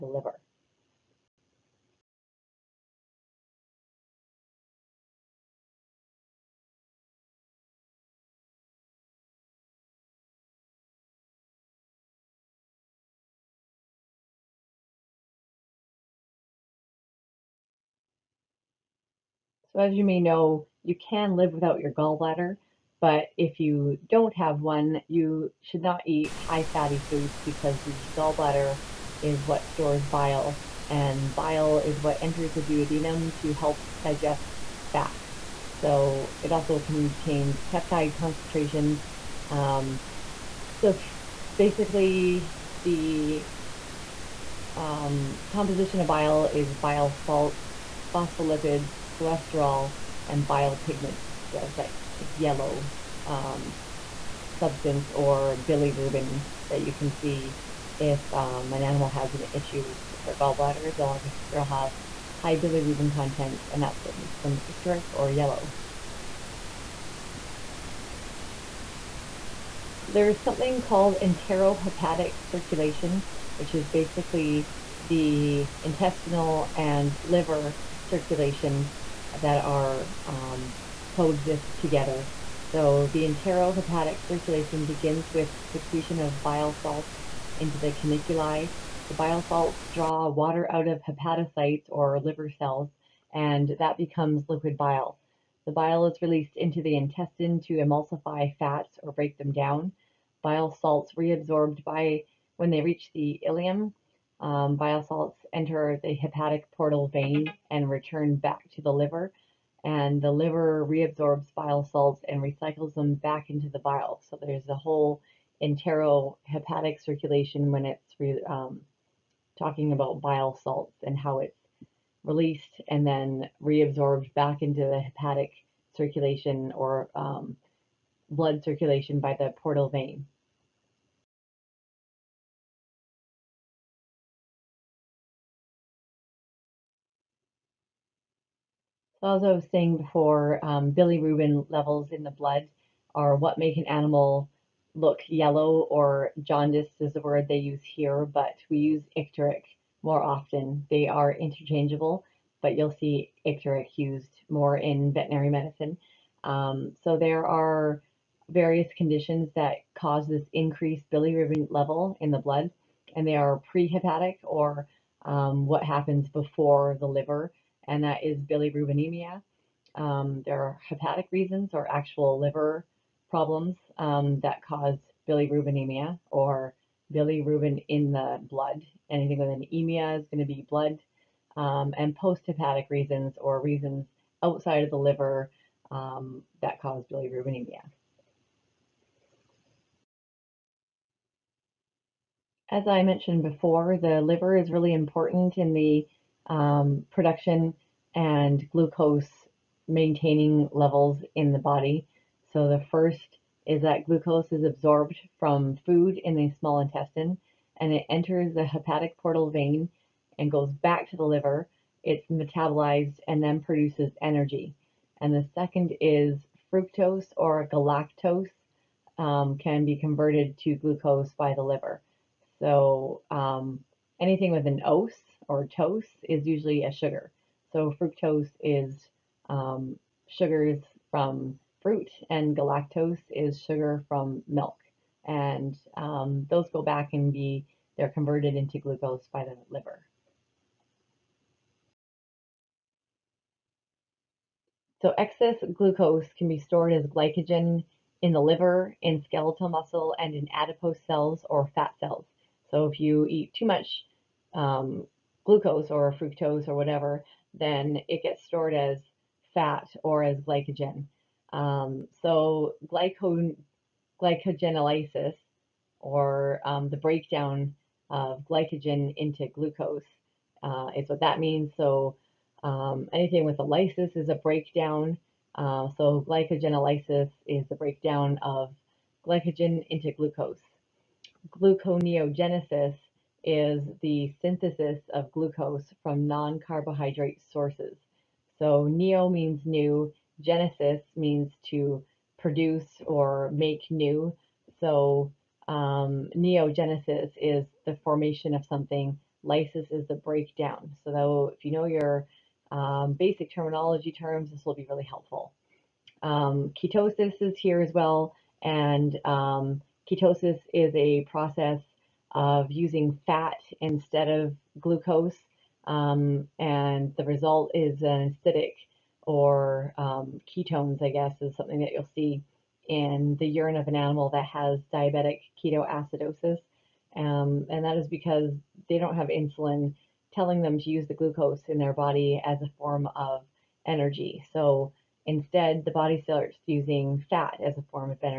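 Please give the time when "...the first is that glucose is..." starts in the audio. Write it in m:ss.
3:22.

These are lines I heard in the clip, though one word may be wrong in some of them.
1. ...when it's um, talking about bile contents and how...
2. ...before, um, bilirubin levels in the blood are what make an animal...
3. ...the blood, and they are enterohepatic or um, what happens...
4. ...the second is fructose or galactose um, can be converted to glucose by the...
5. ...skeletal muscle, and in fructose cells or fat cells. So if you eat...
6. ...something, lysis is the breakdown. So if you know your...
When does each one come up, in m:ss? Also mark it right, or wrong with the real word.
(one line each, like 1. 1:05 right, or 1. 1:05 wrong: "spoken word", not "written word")
1. 1:57 wrong: "salts", not "contents"
2. 2:19 right
3. 2:42 wrong: "prehepatic", not "enterohepatic"
4. 3:35 right
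5. 4:09 wrong: "adipose", not "fructose"
6. 4:58 right.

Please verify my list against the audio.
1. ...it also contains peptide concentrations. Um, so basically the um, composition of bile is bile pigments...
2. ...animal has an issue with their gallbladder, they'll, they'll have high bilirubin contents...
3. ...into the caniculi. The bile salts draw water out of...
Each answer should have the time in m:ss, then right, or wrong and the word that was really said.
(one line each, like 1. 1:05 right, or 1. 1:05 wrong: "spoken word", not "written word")
1. 0:36 wrong: "salts", not "pigments"
2. 0:58 right
3. 1:27 right.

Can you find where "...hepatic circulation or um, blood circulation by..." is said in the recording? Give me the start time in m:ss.
2:05.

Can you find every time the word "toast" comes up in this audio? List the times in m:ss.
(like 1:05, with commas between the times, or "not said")
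3:45.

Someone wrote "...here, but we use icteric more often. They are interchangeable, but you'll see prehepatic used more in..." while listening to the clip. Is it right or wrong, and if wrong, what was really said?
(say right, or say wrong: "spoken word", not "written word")
wrong: "icteric", not "prehepatic".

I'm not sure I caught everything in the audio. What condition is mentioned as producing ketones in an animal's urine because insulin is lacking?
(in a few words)
diabetic ketoacidosis.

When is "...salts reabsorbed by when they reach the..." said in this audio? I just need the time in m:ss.
1:40.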